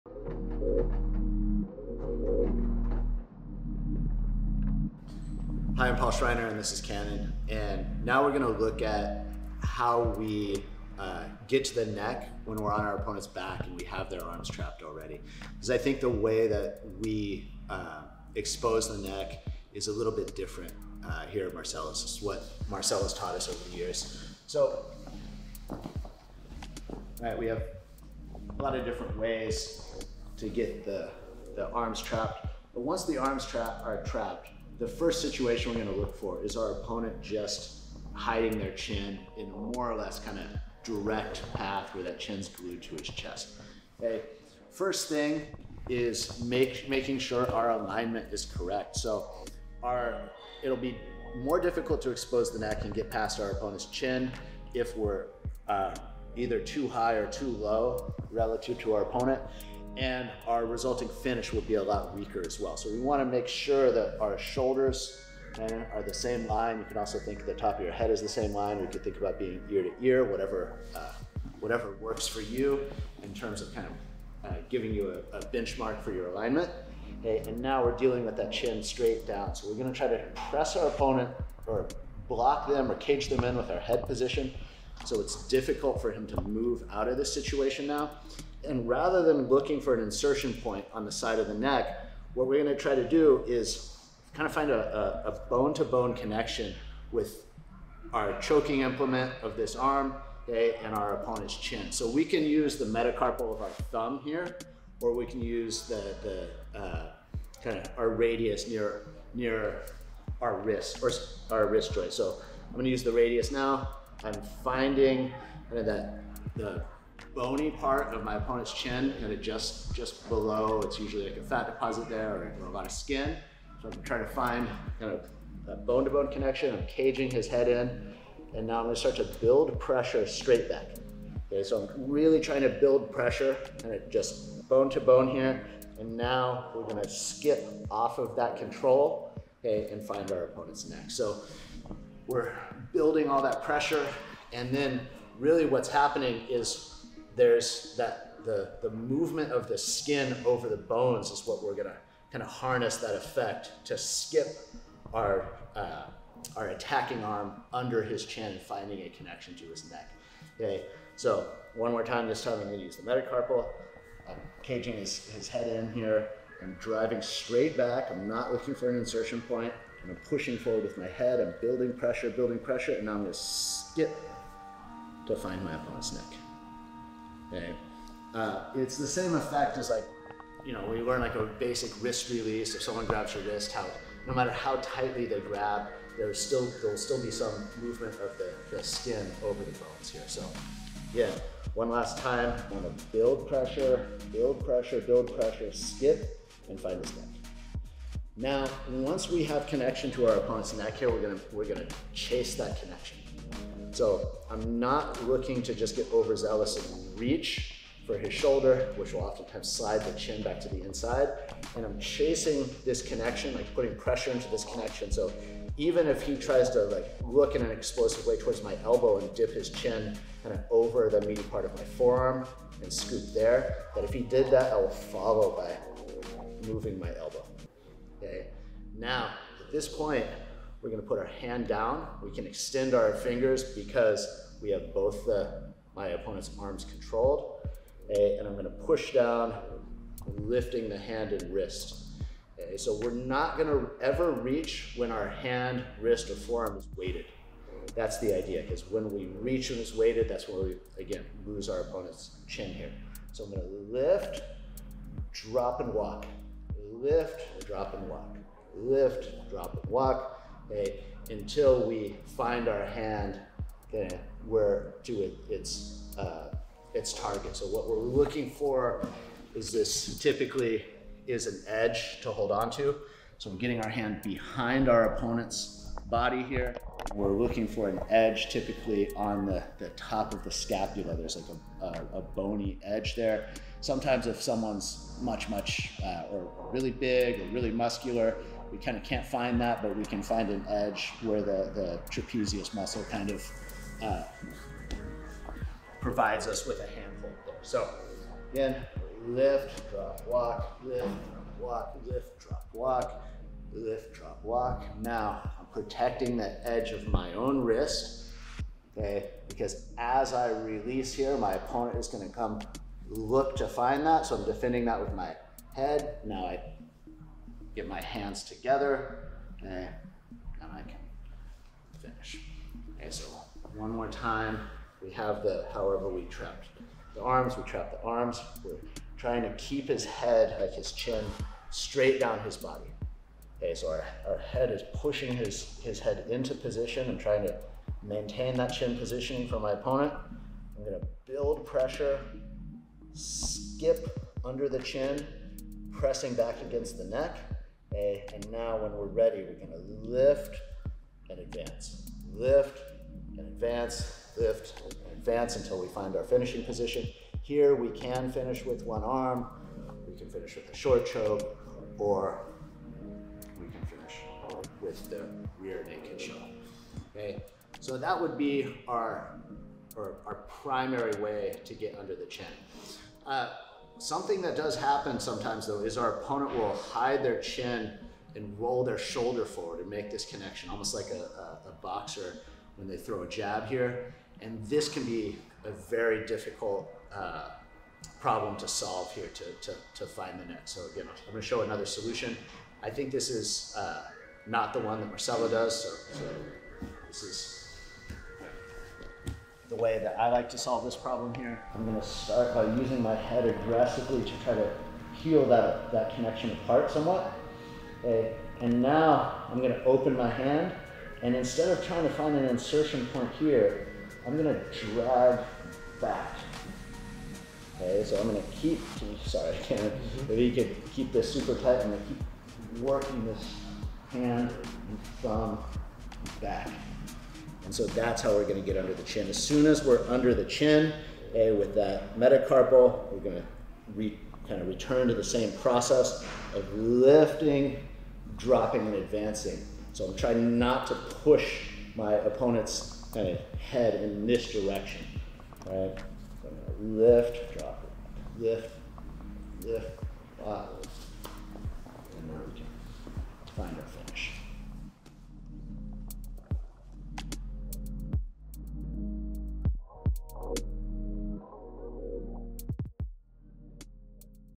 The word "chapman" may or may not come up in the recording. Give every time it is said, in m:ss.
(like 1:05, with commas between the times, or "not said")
not said.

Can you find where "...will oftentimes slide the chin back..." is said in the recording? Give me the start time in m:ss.
3:29.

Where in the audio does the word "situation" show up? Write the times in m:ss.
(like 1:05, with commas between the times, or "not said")
0:35, 1:27.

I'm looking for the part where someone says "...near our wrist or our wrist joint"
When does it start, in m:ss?
1:49.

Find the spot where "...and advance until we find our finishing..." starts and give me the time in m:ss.
5:55.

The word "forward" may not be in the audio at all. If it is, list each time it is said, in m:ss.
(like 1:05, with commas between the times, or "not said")
2:50, 6:19.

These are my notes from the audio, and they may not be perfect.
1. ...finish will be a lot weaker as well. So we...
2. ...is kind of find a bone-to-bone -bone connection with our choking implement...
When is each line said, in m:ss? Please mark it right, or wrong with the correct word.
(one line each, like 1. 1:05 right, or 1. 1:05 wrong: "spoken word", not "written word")
1. 1:01 right
2. 1:33 right.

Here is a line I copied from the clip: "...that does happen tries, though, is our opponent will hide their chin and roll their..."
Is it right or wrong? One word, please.
wrong.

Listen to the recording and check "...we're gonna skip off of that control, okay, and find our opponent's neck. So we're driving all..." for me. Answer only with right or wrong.
wrong.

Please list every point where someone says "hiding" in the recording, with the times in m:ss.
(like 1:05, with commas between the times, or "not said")
0:38.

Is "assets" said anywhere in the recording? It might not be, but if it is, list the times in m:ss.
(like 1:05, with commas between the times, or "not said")
not said.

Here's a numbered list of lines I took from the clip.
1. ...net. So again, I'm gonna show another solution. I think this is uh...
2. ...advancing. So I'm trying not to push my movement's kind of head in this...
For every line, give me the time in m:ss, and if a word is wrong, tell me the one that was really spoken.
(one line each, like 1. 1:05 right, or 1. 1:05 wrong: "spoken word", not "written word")
1. 6:30 right
2. 7:18 wrong: "opponent", not "movement".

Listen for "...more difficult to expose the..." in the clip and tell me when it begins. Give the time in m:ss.
0:51.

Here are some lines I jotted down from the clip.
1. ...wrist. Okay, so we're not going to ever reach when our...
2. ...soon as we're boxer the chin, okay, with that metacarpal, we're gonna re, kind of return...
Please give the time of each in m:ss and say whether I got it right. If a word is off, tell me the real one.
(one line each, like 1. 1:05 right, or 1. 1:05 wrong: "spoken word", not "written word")
1. 4:01 right
2. 7:09 wrong: "under", not "boxer".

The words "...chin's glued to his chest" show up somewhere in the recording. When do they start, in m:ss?
0:42.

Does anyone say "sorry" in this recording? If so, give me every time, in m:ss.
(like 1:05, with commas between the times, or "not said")
6:59.